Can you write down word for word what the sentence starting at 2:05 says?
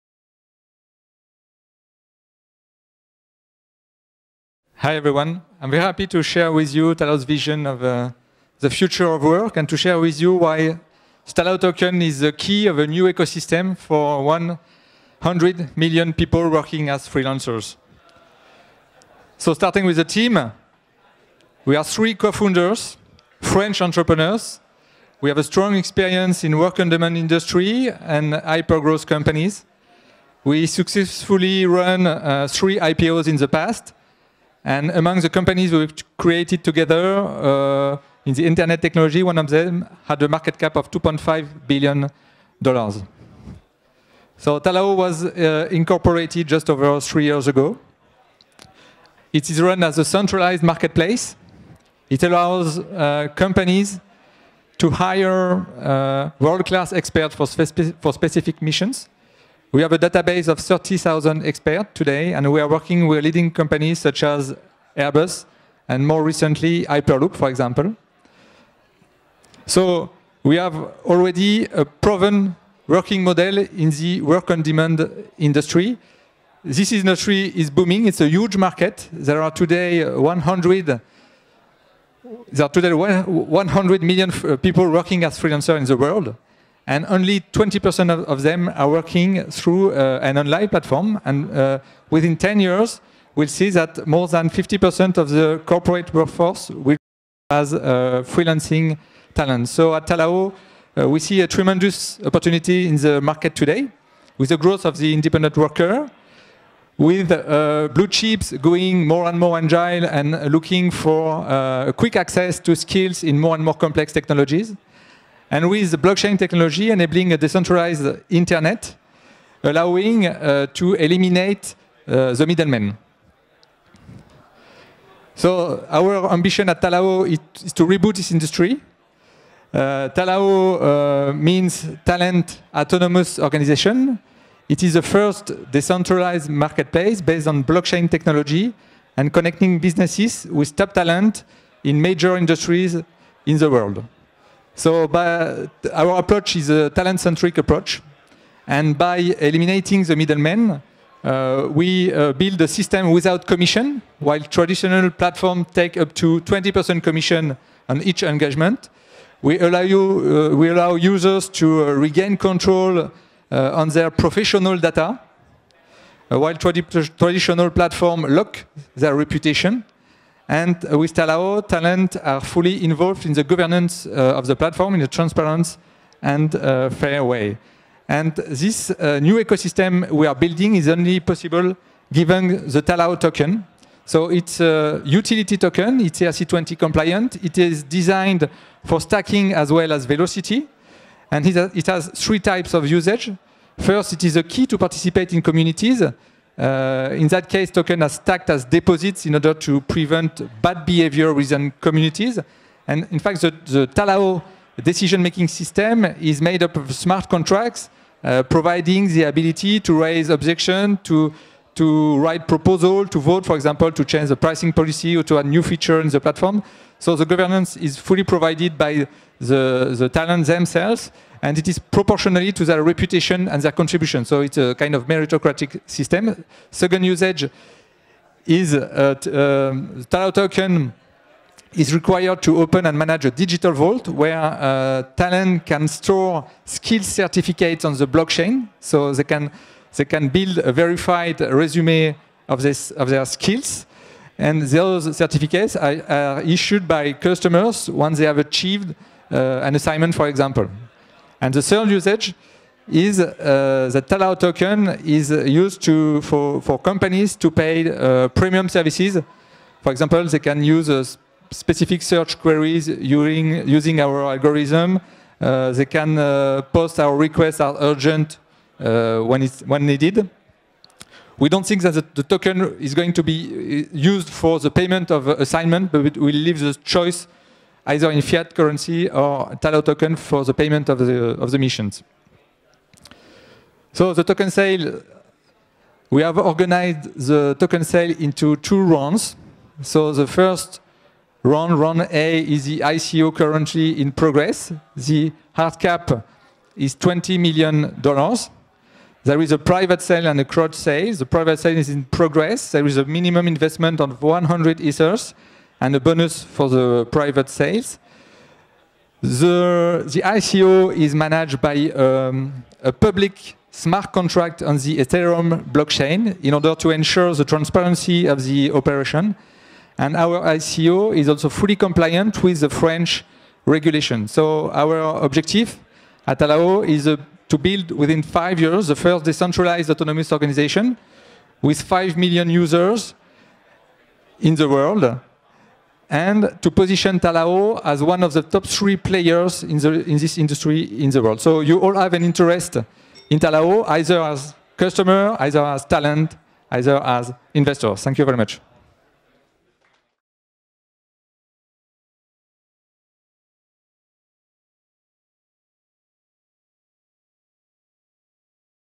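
So our ambition at Talao is, to reboot this industry.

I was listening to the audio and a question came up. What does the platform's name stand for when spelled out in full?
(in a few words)
Talent Autonomous Organization.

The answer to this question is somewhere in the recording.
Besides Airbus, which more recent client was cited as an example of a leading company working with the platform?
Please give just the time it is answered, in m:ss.
1:06.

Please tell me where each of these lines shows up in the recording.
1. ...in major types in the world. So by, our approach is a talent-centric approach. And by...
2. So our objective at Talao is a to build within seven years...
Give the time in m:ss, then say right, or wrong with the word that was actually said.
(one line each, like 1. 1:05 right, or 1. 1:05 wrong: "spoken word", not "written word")
1. 2:21 wrong: "industries", not "types"
2. 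5:24 wrong: "five", not "seven".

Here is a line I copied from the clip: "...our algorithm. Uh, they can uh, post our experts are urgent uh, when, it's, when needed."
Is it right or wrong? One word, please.
wrong.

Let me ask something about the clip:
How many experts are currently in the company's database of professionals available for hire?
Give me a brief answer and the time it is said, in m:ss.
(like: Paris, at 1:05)
30,000, at 1:00.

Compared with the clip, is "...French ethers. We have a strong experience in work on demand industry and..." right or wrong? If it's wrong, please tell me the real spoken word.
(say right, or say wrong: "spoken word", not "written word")
wrong: "entrepreneurs", not "ethers".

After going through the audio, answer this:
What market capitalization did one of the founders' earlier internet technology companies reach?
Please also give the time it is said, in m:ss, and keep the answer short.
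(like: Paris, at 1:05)
$2.5 billion, at 0:40.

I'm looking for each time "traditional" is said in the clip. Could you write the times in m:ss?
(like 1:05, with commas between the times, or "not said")
2:34, 2:46.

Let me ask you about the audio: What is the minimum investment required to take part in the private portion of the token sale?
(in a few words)
100 ether.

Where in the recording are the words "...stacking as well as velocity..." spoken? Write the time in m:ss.
3:08.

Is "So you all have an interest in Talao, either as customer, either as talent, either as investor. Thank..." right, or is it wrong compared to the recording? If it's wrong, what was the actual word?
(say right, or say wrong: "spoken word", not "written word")
right.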